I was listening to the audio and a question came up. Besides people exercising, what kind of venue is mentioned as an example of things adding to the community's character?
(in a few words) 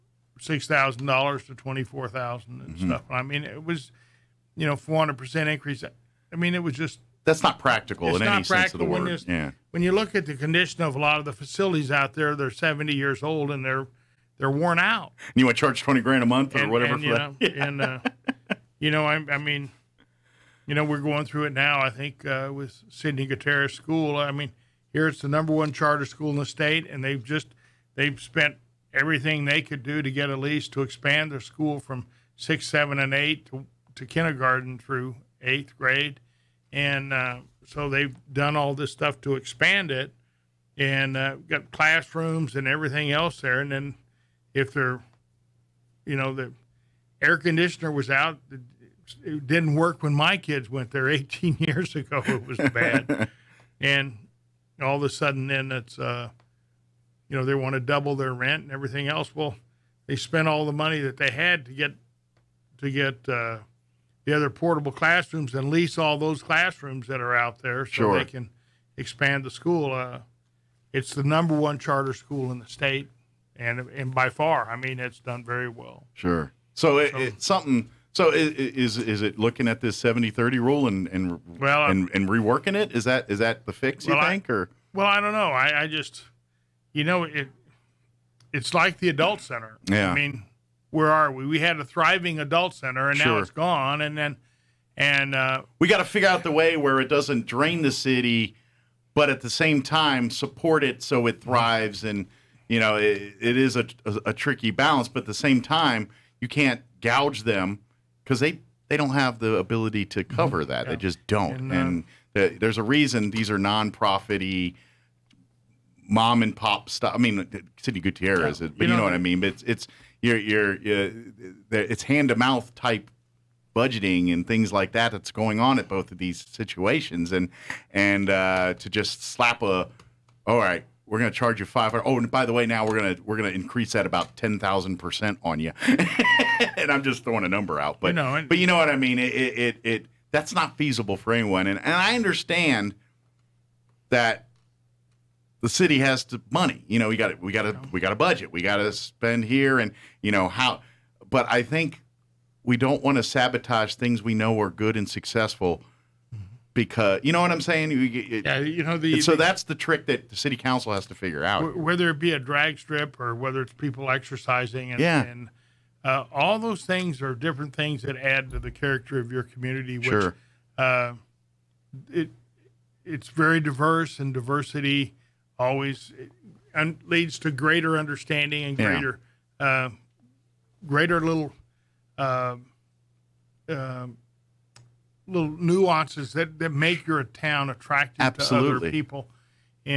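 drag strip.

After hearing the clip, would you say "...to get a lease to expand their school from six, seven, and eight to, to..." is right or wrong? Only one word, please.
right.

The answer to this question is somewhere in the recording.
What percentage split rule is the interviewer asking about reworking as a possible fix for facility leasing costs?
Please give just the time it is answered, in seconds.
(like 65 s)
80 s.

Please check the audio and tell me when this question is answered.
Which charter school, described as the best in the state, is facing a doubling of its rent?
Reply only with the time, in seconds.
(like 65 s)
22 s.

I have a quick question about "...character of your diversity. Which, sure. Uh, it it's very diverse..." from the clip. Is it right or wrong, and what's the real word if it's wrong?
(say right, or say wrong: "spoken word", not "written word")
wrong: "community", not "diversity".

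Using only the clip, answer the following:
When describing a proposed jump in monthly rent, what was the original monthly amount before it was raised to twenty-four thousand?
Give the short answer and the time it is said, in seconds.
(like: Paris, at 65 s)
$6,000, at 0 s.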